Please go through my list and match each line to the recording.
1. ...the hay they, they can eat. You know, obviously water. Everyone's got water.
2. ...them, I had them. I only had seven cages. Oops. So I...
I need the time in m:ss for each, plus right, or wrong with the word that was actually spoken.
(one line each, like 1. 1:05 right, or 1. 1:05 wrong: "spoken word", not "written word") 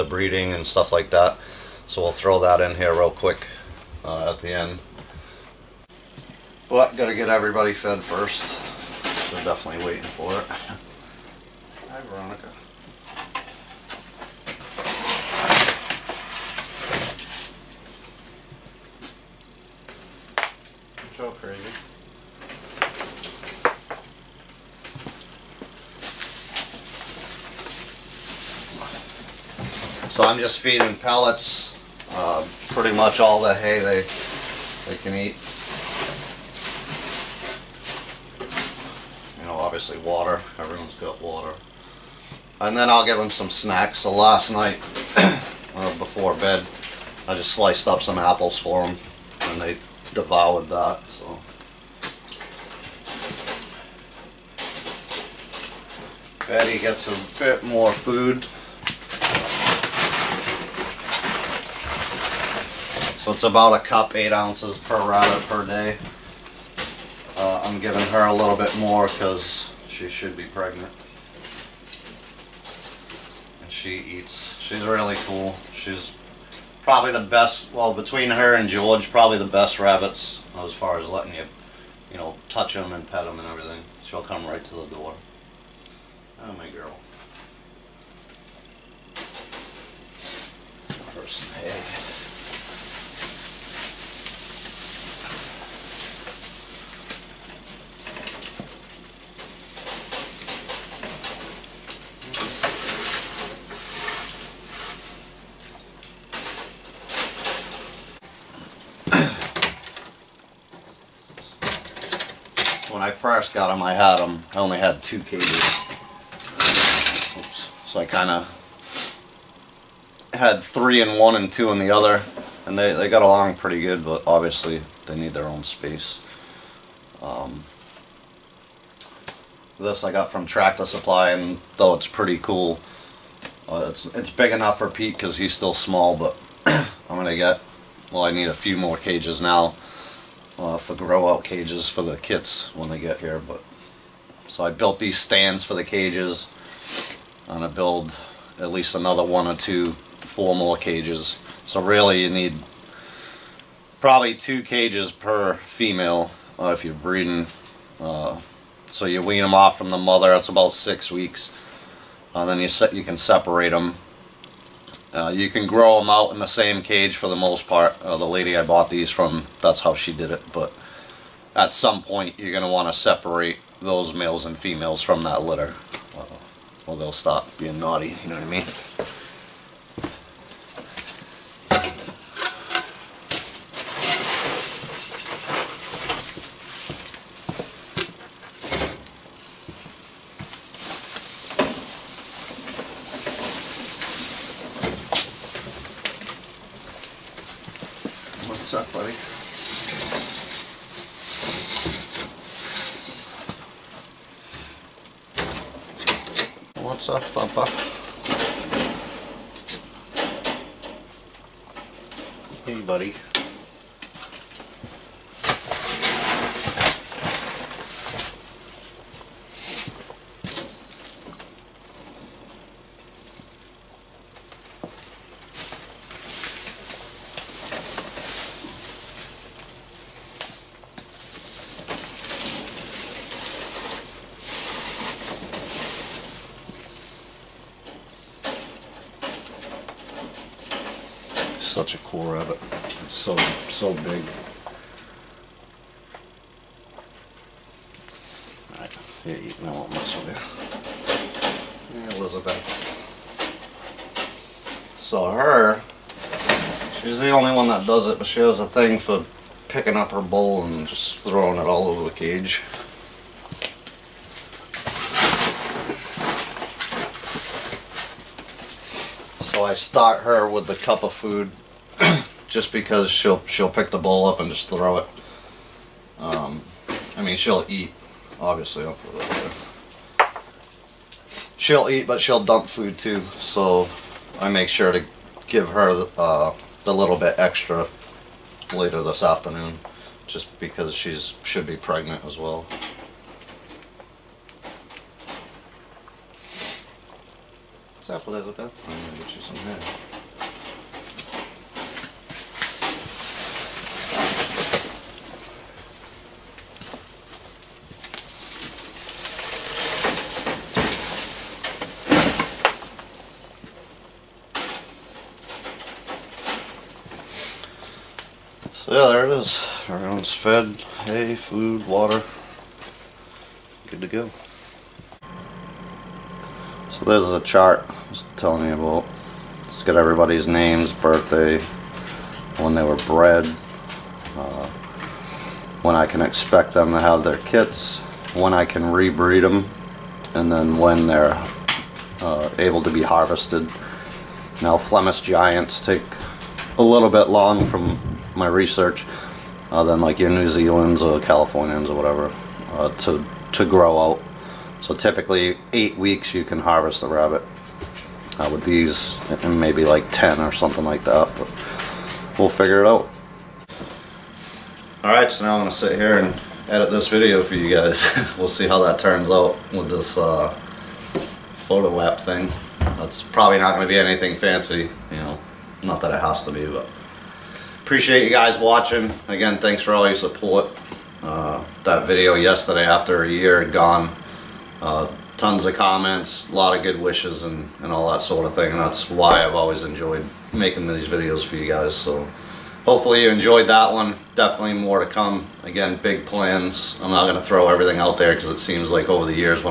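1. 0:33 right
2. 1:53 wrong: "two", not "seven".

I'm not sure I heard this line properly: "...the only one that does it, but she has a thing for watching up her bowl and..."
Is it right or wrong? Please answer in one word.
wrong.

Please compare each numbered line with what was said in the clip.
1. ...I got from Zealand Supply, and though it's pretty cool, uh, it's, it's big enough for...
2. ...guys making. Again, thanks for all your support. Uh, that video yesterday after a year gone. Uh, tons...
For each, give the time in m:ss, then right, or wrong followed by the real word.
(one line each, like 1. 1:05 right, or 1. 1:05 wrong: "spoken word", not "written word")
1. 2:10 wrong: "Tractor", not "Zealand"
2. 6:18 wrong: "watching", not "making".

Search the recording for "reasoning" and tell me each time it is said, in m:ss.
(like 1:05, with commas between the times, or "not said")
not said.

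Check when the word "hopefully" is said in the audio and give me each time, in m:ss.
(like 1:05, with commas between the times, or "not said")
6:32.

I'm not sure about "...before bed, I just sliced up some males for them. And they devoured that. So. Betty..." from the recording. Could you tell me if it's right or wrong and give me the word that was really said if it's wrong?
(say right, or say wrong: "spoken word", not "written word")
wrong: "apples", not "males".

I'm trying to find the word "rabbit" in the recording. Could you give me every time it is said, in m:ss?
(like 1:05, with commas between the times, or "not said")
1:05, 1:19, 5:57.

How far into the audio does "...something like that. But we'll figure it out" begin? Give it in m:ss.
6:00.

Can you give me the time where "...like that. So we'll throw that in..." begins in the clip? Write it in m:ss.
0:00.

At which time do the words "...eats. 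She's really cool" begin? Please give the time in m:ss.
1:13.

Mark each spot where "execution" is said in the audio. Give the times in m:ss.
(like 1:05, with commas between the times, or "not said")
not said.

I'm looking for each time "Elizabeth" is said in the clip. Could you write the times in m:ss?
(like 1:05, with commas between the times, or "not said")
4:12, 4:58.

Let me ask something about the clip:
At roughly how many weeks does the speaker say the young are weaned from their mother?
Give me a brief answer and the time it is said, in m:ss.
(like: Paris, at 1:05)
6 weeks, at 2:40.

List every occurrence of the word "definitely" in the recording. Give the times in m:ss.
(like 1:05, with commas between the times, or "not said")
0:09, 6:34.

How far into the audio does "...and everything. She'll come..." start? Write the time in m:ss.
1:23.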